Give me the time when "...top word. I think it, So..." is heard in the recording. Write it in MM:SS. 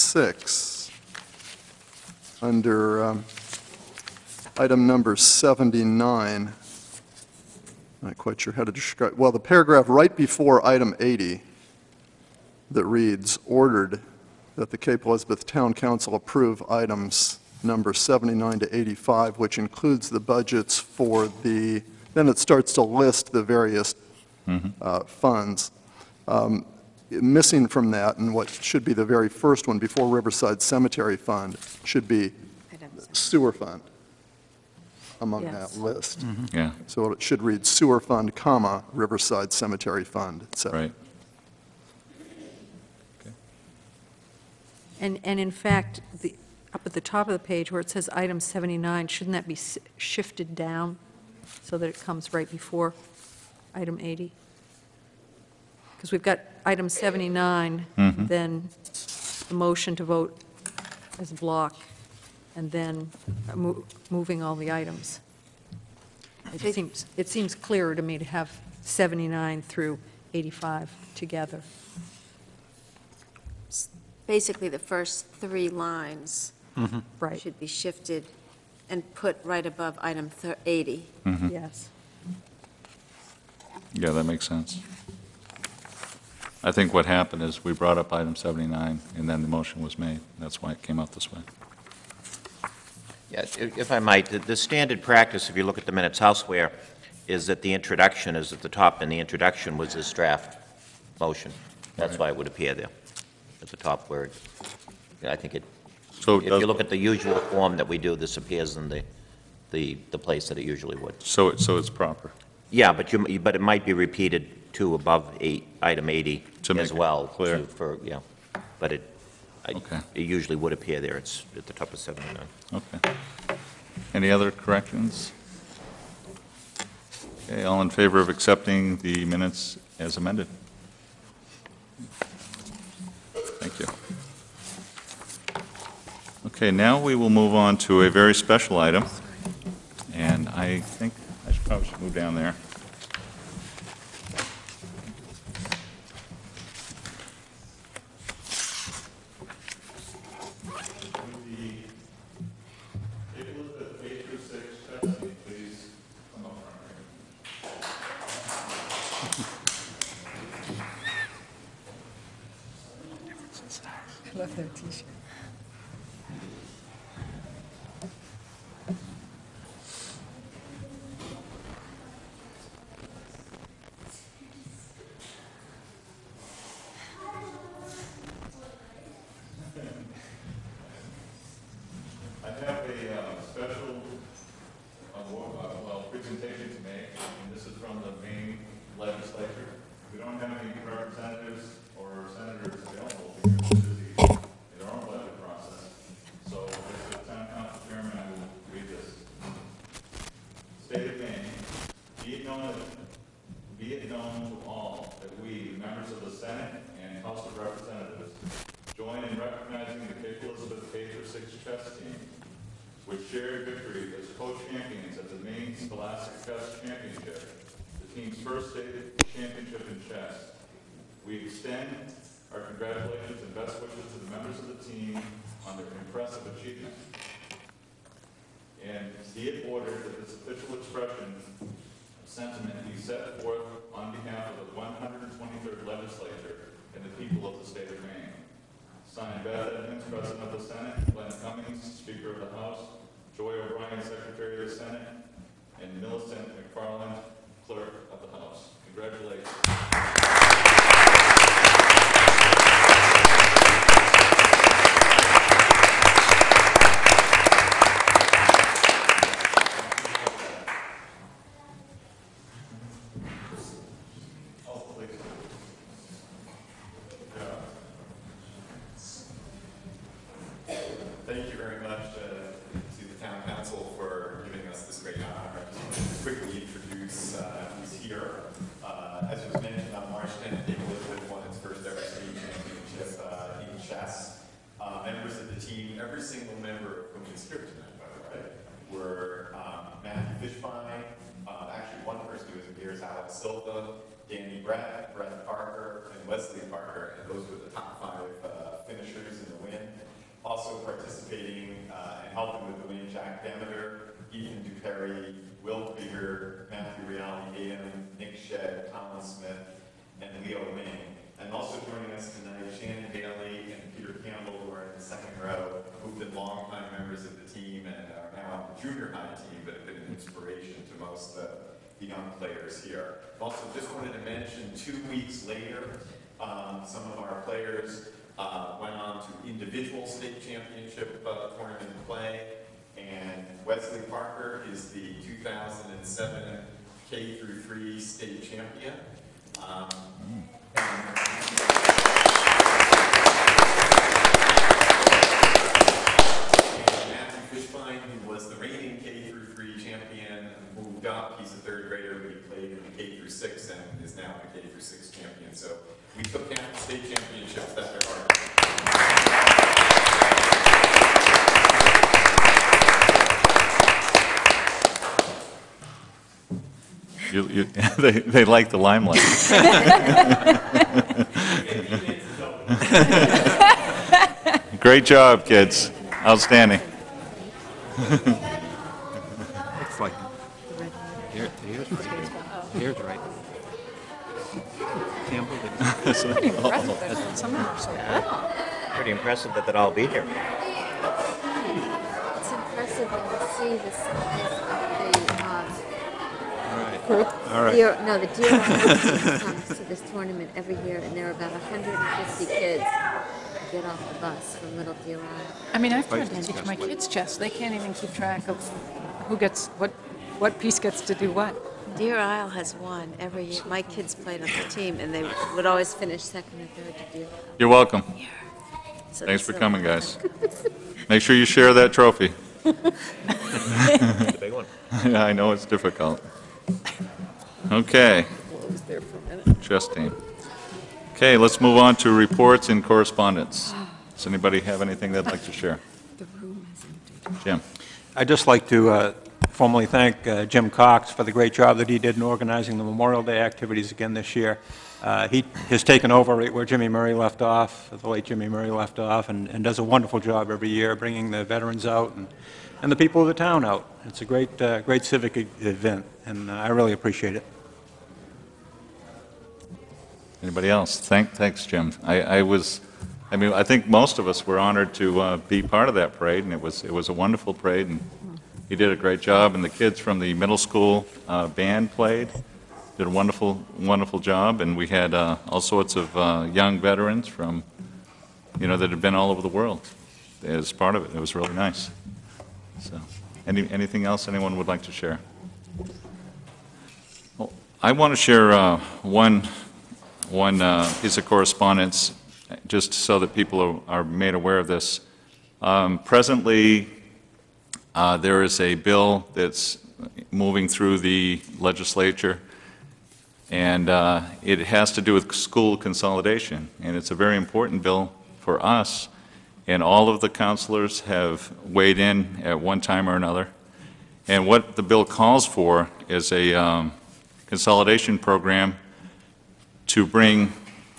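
01:43.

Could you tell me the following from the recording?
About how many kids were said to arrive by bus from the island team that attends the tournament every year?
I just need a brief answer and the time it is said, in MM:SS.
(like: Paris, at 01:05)
150, at 06:41.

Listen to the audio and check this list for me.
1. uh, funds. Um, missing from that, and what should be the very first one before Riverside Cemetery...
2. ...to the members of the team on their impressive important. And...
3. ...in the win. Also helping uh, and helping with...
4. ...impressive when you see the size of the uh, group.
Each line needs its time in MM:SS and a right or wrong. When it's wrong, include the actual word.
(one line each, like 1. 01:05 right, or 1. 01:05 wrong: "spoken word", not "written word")
1. 00:24 right
2. 03:44 wrong: "achievement", not "important"
3. 04:59 wrong: "participating", not "helping"
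4. 06:32 right.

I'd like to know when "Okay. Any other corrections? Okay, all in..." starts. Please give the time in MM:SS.
02:02.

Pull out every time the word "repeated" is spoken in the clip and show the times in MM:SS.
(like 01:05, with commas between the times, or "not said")
01:53.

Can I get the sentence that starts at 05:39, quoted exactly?
Um, and, Dopp, he's a third grader, but he played in K through six and is now a K through six champion.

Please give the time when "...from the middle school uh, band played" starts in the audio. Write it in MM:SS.
07:50.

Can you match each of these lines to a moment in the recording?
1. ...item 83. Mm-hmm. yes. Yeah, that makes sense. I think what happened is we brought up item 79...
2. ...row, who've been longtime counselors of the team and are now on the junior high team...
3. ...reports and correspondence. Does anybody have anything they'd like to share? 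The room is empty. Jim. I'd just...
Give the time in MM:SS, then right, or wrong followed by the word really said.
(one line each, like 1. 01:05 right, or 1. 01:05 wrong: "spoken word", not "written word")
1. 01:20 wrong: "80", not "83"
2. 05:15 wrong: "members", not "counselors"
3. 07:12 right.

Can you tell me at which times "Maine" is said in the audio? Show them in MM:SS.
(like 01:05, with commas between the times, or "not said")
03:58.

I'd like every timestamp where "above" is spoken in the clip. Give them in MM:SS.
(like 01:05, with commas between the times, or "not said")
01:19, 01:54.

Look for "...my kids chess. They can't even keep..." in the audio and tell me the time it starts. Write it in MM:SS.
06:46.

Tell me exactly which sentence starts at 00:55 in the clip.
Because we've got item 79, mm-hmm.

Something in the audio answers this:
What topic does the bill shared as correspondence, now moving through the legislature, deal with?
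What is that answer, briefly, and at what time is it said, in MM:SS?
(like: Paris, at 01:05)
School consolidation, at 08:25.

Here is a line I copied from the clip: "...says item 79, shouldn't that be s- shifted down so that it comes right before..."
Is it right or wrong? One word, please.
right.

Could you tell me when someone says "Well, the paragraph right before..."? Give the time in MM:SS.
00:09.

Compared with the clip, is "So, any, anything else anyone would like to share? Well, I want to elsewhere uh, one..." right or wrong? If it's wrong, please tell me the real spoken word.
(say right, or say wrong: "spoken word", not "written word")
wrong: "share", not "elsewhere".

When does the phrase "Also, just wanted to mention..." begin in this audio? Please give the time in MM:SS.
05:23.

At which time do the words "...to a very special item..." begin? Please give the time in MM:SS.
02:17.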